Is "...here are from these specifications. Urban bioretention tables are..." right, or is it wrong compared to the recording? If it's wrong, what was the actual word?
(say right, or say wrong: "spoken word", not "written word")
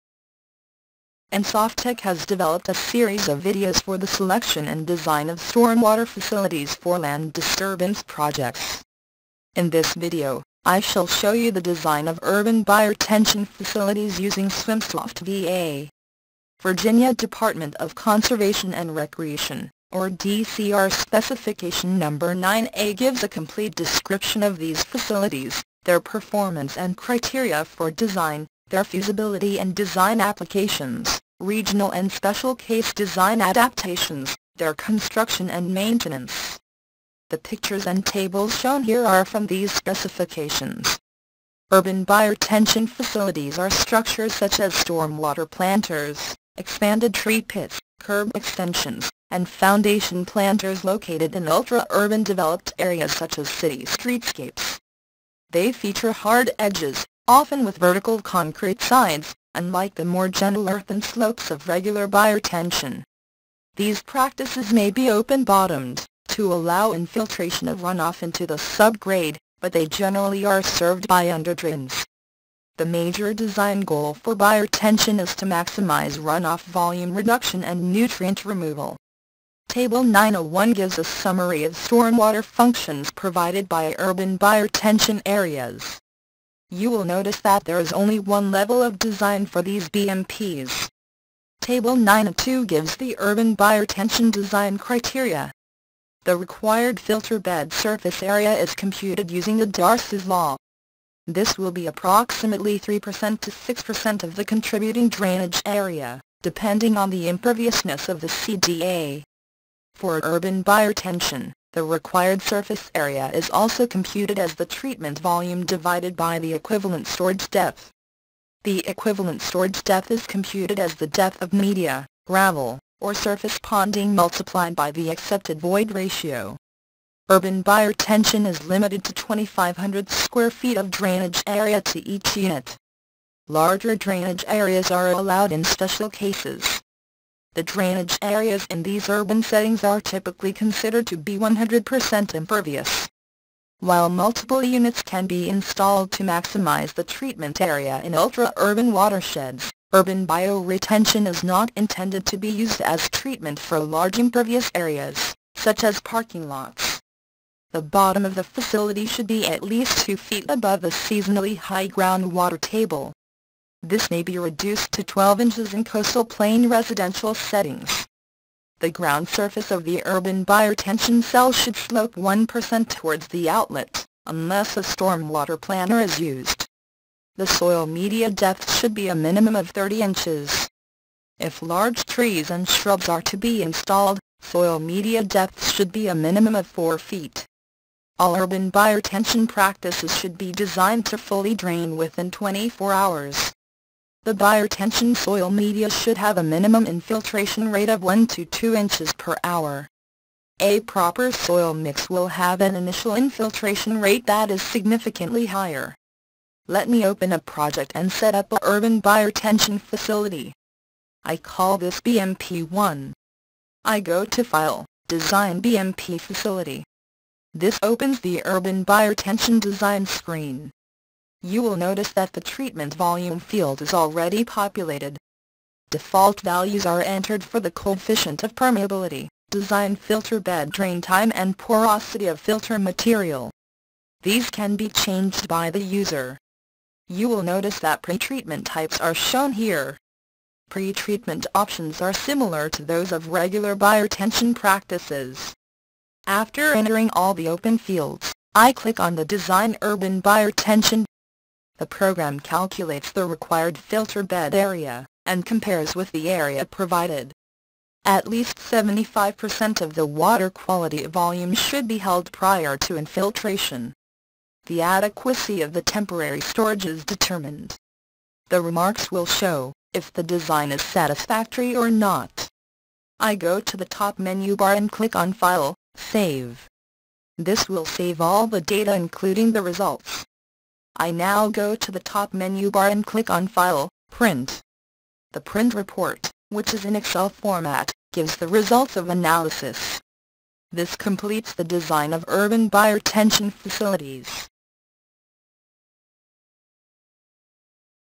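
wrong: "facilities", not "tables".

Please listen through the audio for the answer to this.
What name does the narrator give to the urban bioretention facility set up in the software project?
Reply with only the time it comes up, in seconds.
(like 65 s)
212 s.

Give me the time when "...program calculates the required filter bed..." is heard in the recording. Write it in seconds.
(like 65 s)
251 s.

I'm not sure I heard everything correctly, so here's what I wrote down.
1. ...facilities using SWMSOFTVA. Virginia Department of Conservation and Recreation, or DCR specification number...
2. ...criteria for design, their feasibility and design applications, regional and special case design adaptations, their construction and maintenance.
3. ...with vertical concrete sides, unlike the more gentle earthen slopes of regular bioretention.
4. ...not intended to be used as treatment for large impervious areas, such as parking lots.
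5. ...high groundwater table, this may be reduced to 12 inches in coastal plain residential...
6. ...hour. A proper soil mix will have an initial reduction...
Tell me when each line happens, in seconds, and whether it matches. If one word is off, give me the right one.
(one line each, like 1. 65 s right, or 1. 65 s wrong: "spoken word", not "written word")
1. 13 s right
2. 26 s right
3. 57 s right
4. 151 s right
5. 161 s right
6. 199 s wrong: "infiltration", not "reduction".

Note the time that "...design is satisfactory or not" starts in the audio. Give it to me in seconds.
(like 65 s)
270 s.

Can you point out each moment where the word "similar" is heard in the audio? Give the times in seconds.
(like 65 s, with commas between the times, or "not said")
242 s.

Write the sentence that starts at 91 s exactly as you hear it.
Table 9.2 gives the urban bioretention design criteria.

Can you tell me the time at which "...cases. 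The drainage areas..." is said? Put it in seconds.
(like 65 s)
136 s.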